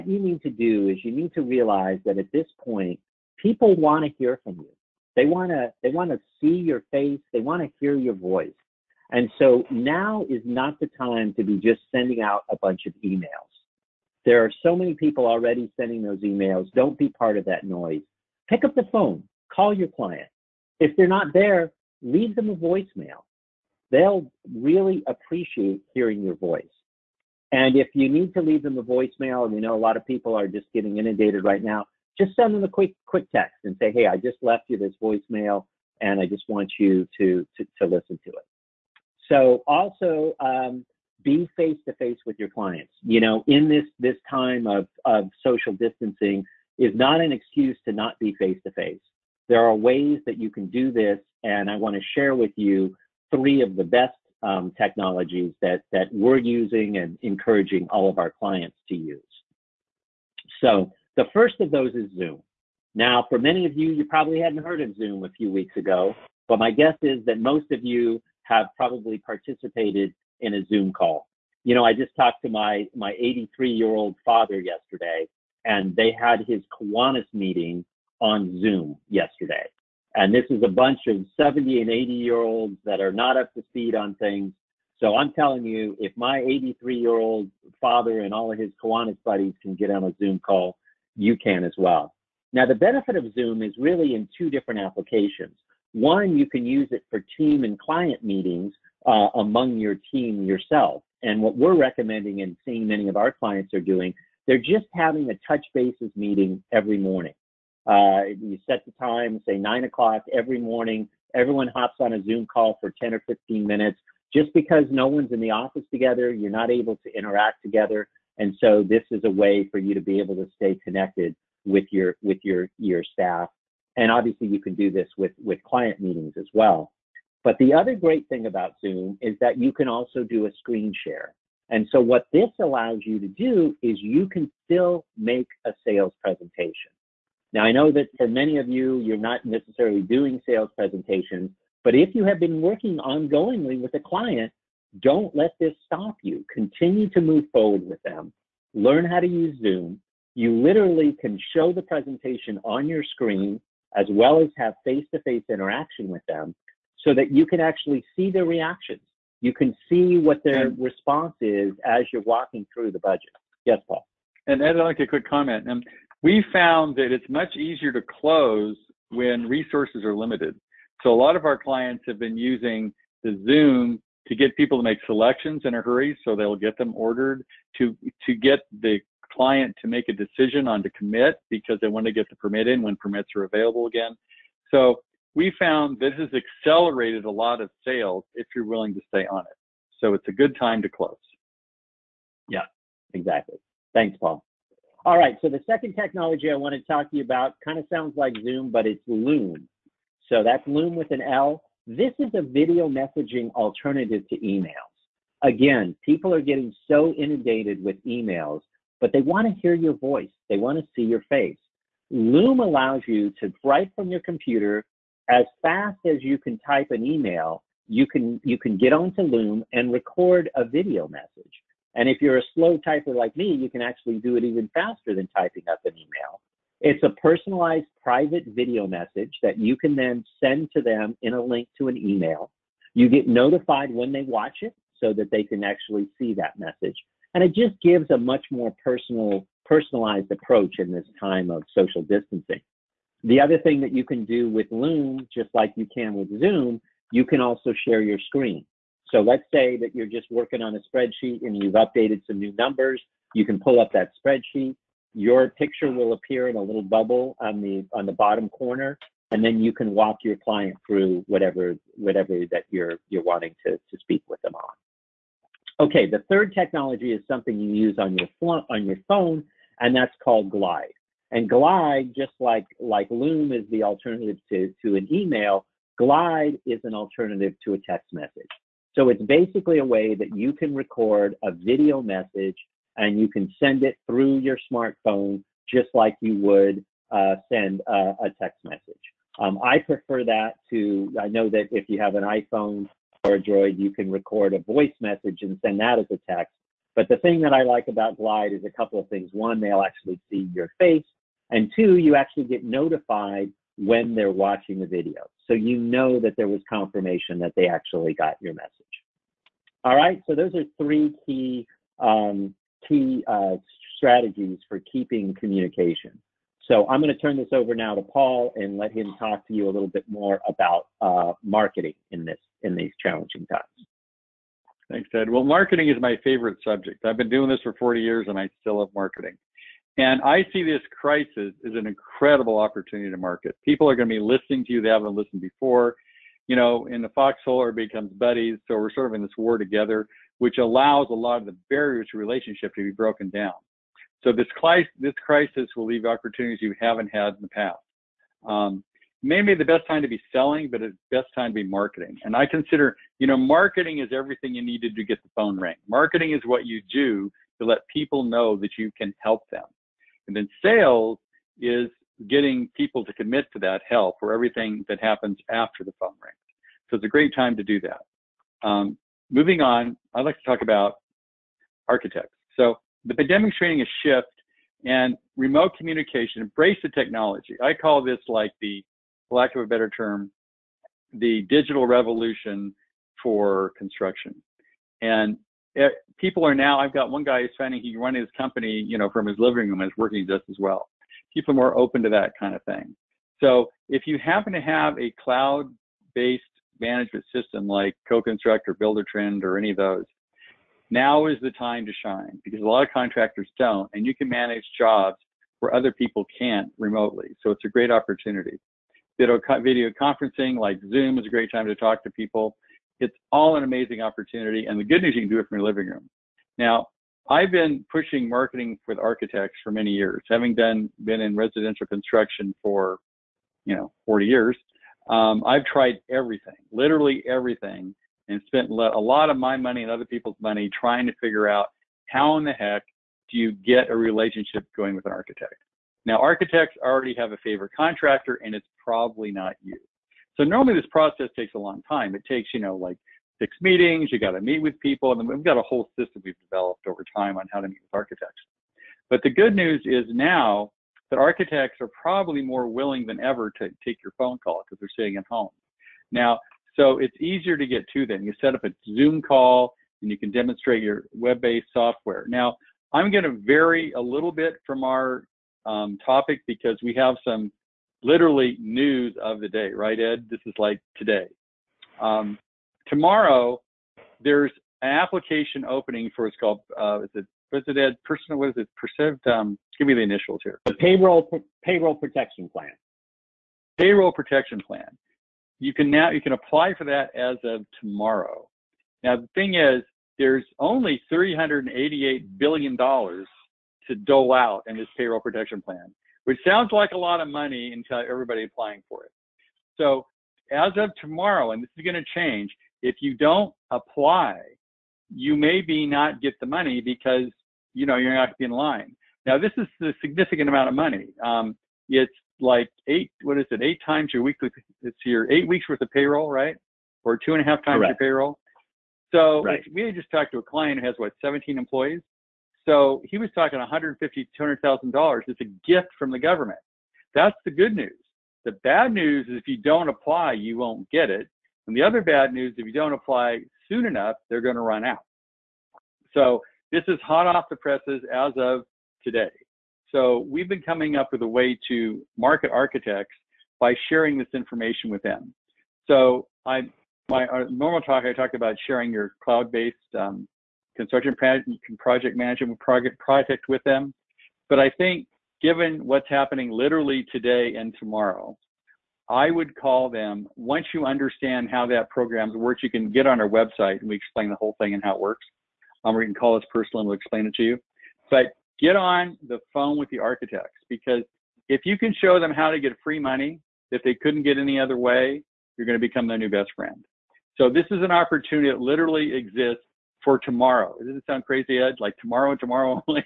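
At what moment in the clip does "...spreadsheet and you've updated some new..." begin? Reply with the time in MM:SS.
04:10.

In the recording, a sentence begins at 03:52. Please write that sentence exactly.
You get notified when they watch it so that they can actually see that message.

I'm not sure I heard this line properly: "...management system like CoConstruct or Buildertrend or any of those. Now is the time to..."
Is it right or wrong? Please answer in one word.
right.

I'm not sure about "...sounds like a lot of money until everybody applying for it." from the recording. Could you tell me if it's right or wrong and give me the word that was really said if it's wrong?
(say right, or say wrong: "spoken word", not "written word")
right.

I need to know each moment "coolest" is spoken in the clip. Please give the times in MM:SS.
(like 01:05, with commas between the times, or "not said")
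not said.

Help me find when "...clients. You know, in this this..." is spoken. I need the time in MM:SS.
00:42.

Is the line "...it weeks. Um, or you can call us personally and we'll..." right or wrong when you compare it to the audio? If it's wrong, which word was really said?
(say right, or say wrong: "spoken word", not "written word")
wrong: "works", not "weeks".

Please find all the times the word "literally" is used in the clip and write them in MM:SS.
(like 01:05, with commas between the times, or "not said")
02:30, 07:06, 07:48, 09:16, 09:38.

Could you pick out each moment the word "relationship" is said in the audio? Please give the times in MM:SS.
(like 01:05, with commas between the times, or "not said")
05:42, 07:13.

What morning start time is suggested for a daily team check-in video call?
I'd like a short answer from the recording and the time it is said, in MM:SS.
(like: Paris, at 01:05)
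9 o'clock, at 01:49.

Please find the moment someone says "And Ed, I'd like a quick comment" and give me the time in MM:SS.
02:44.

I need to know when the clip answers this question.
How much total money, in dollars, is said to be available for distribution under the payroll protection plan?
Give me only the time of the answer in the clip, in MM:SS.
08:11.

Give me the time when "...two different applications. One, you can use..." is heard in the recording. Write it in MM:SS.
01:34.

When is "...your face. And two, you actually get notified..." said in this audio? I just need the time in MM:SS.
05:00.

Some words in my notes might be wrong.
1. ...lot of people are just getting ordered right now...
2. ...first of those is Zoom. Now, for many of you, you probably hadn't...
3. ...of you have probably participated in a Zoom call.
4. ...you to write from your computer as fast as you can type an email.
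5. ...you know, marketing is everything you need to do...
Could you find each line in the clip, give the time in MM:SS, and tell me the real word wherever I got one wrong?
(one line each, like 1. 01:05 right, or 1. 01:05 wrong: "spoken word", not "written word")
1. 00:29 wrong: "inundated", not "ordered"
2. 01:01 right
3. 01:07 right
4. 03:33 right
5. 05:53 right.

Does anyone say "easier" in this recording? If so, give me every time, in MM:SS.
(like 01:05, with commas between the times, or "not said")
02:47, 07:37.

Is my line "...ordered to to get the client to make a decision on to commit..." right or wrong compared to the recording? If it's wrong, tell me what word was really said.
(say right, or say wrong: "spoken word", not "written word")
right.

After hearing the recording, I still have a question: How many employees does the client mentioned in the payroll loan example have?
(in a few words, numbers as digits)
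17.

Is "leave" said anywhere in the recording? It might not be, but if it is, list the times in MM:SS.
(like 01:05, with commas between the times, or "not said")
00:22, 00:28, 05:45.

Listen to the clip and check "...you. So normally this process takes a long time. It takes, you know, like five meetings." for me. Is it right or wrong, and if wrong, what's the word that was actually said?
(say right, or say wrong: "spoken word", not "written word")
wrong: "six", not "five".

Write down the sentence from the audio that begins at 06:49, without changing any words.
Video, video conferencing like Zoom is a great time to talk to people.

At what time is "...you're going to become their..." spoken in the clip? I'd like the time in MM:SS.
09:35.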